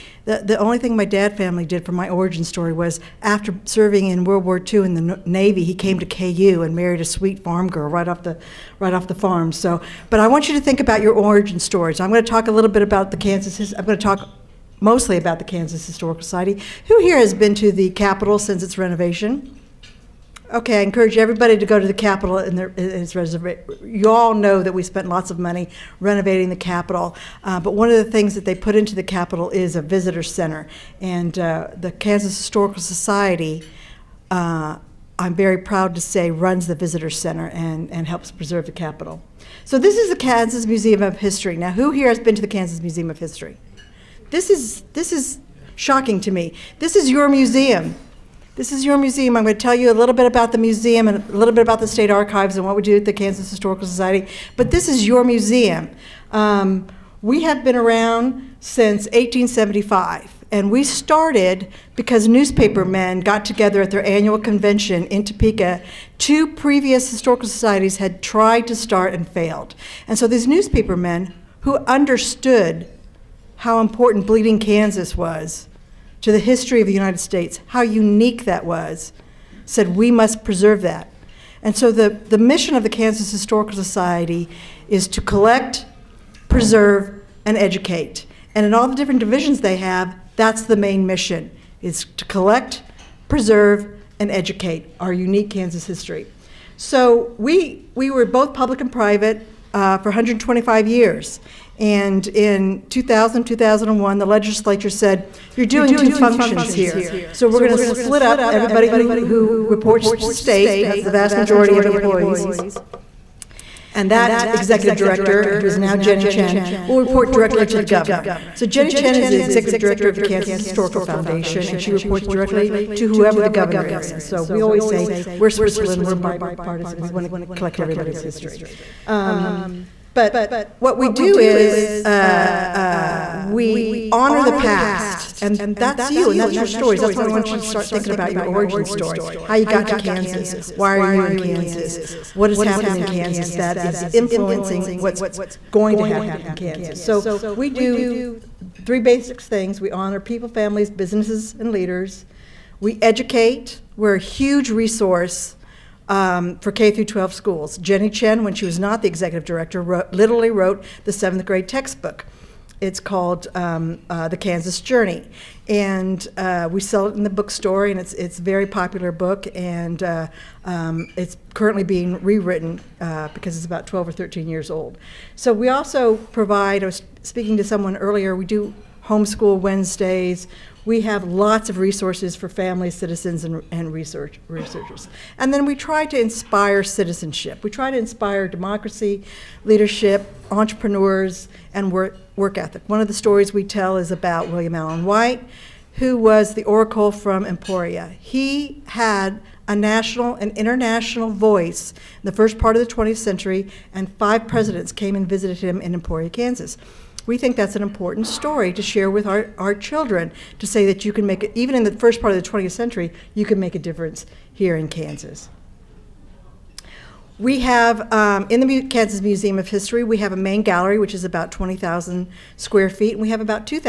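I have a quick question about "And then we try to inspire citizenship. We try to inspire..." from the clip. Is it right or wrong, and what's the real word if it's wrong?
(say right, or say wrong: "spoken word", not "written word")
right.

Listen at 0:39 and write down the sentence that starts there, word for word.
So this is the Kansas Museum of History.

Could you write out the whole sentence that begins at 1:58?
So Jenny Chinn is the executive director of the Kansas Historical Foundation, and she reports directly to whoever the governor is.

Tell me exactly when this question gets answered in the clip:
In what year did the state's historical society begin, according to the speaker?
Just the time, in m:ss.
0:59.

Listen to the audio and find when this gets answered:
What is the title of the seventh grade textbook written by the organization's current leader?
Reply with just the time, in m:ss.
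2:44.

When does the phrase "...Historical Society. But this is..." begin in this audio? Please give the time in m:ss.
0:53.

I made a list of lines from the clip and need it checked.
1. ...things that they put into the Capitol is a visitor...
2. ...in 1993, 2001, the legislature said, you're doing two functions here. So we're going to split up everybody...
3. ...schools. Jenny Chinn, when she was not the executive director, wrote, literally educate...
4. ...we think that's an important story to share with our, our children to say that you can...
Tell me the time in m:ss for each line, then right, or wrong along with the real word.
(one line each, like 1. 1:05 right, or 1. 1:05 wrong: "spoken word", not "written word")
1. 0:28 right
2. 1:42 wrong: "2000", not "1993"
3. 2:37 wrong: "wrote", not "educate"
4. 3:27 right.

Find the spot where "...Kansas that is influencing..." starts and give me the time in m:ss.
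2:23.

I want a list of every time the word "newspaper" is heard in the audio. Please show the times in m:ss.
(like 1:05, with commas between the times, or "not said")
1:02, 1:10.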